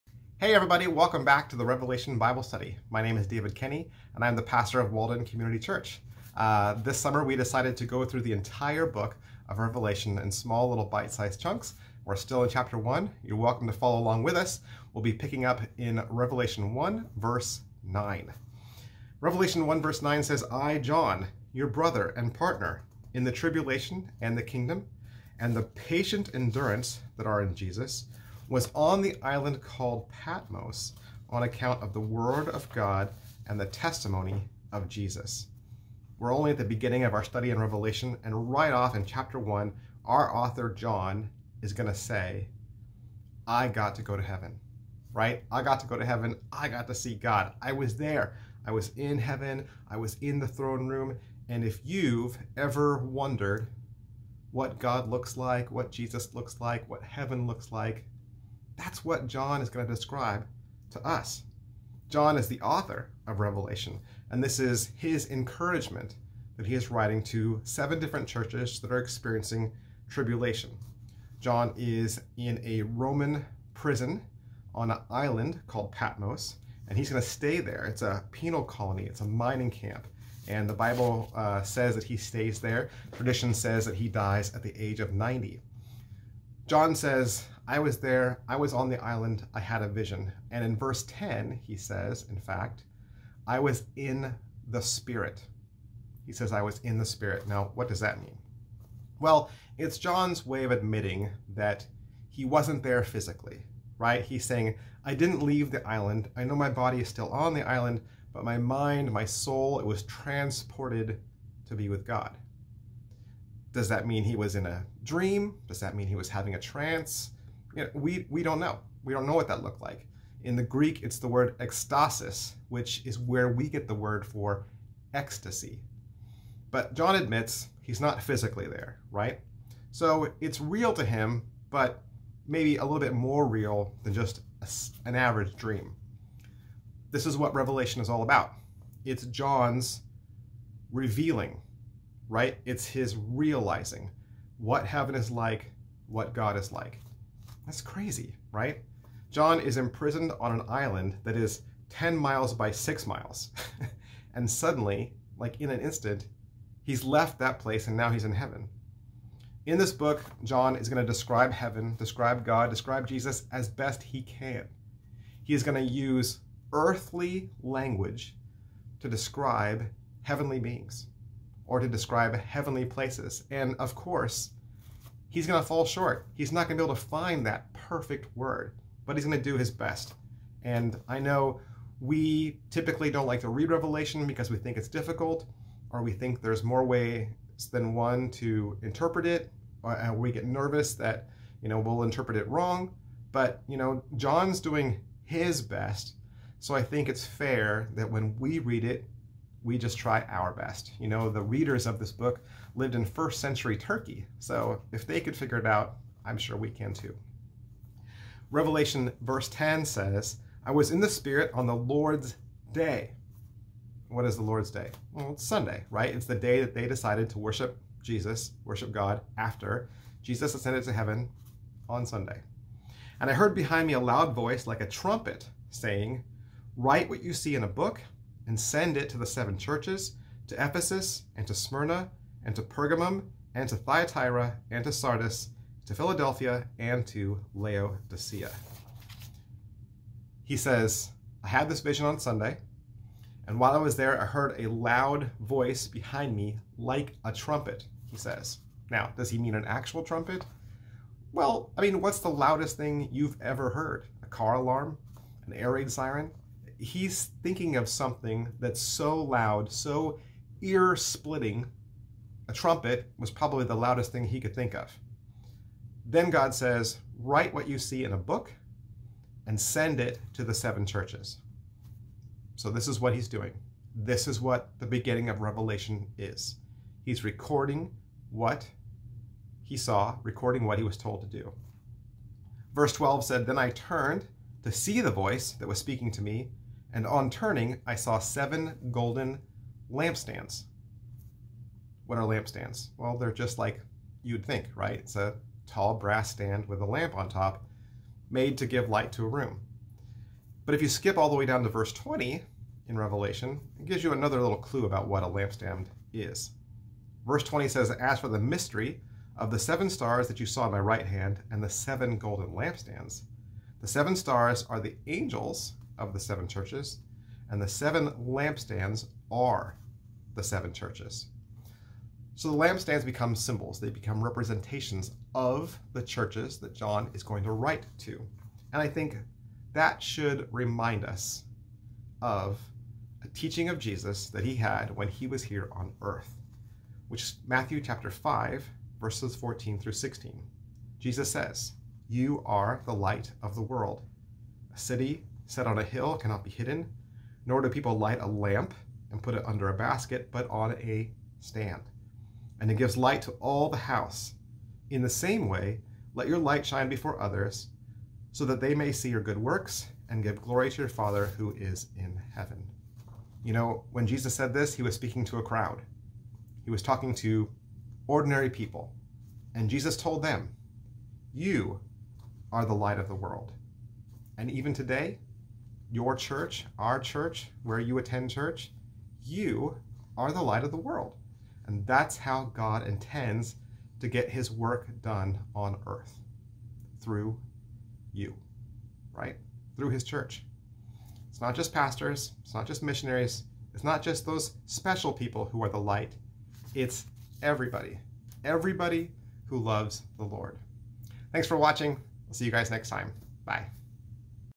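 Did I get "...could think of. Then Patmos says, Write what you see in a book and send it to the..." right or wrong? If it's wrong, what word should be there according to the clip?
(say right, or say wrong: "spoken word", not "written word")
wrong: "God", not "Patmos".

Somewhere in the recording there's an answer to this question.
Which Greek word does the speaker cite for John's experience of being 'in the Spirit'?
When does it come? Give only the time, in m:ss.
2:01.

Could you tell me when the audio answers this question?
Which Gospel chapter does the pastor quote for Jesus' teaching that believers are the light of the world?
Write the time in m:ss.
5:37.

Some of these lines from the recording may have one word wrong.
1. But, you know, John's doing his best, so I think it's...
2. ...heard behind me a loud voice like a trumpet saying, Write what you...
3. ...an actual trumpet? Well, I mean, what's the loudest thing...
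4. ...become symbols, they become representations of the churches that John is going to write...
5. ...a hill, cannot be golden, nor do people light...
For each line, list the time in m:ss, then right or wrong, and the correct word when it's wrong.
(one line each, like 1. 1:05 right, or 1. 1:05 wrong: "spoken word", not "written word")
1. 3:13 right
2. 3:43 right
3. 4:09 right
4. 5:23 right
5. 5:45 wrong: "hidden", not "golden".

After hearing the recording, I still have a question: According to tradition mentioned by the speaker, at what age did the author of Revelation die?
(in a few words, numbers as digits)
90.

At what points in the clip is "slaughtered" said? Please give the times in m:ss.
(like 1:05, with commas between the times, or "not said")
not said.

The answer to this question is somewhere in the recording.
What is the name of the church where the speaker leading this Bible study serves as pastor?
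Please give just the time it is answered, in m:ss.
0:04.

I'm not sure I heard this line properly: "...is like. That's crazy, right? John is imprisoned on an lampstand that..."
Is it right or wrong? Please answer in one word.
wrong.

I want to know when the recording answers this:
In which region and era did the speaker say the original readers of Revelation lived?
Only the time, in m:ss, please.
3:23.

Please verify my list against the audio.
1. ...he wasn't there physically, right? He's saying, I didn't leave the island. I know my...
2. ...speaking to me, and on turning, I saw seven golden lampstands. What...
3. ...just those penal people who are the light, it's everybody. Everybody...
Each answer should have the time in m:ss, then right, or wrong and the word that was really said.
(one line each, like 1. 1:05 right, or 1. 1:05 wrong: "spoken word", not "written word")
1. 1:42 right
2. 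4:45 right
3. 6:34 wrong: "special", not "penal".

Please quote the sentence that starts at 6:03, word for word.
You know, when Jesus said this, he was speaking to a crowd.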